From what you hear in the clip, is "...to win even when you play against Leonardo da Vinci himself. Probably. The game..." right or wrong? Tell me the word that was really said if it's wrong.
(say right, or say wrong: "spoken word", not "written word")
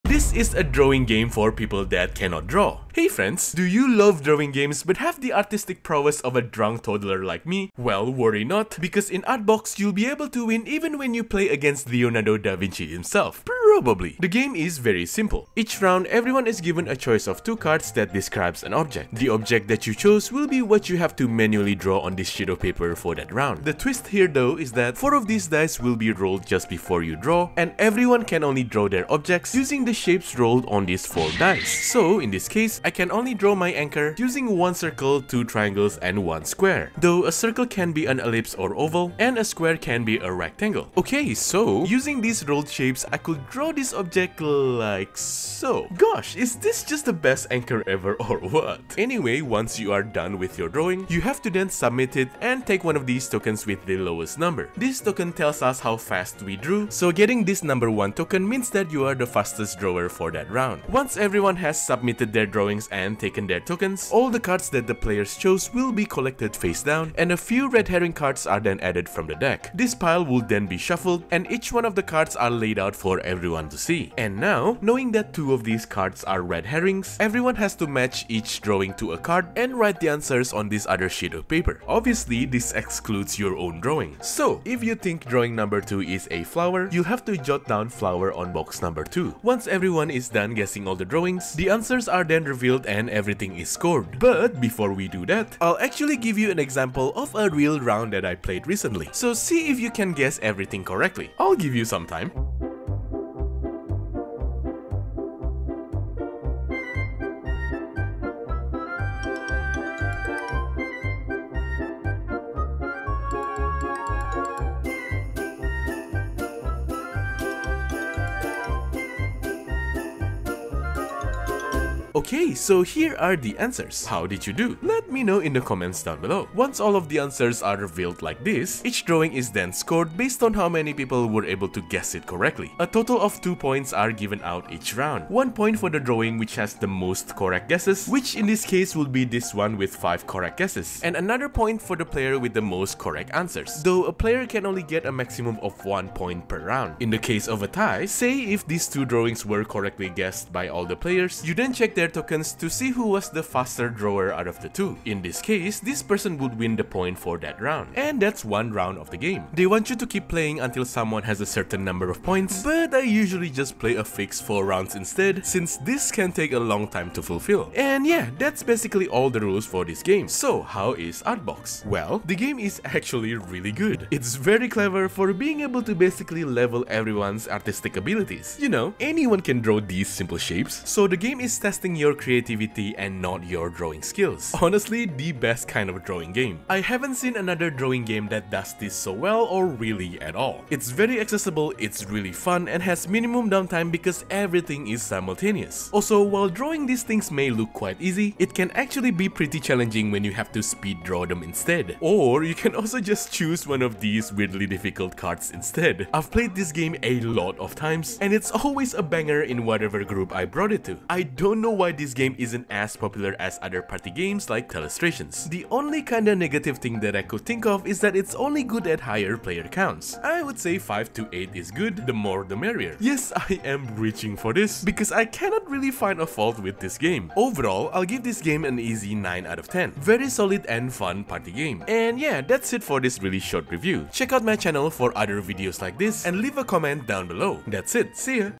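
right.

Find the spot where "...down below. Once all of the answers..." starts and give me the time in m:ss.
2:06.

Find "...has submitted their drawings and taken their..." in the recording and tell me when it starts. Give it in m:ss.
1:01.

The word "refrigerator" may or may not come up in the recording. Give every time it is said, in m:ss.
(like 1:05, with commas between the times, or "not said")
not said.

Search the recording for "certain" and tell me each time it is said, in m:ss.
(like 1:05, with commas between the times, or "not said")
2:41.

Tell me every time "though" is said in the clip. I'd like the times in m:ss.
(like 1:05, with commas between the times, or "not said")
0:24, 0:36, 2:23.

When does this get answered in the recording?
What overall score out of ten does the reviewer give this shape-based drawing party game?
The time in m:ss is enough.
3:49.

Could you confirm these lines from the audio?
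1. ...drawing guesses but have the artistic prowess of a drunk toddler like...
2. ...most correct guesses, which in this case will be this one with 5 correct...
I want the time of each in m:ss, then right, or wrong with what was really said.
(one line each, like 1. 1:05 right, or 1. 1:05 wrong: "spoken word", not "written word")
1. 0:04 wrong: "games", not "guesses"
2. 2:16 right.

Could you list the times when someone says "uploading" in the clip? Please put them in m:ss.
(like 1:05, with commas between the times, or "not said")
not said.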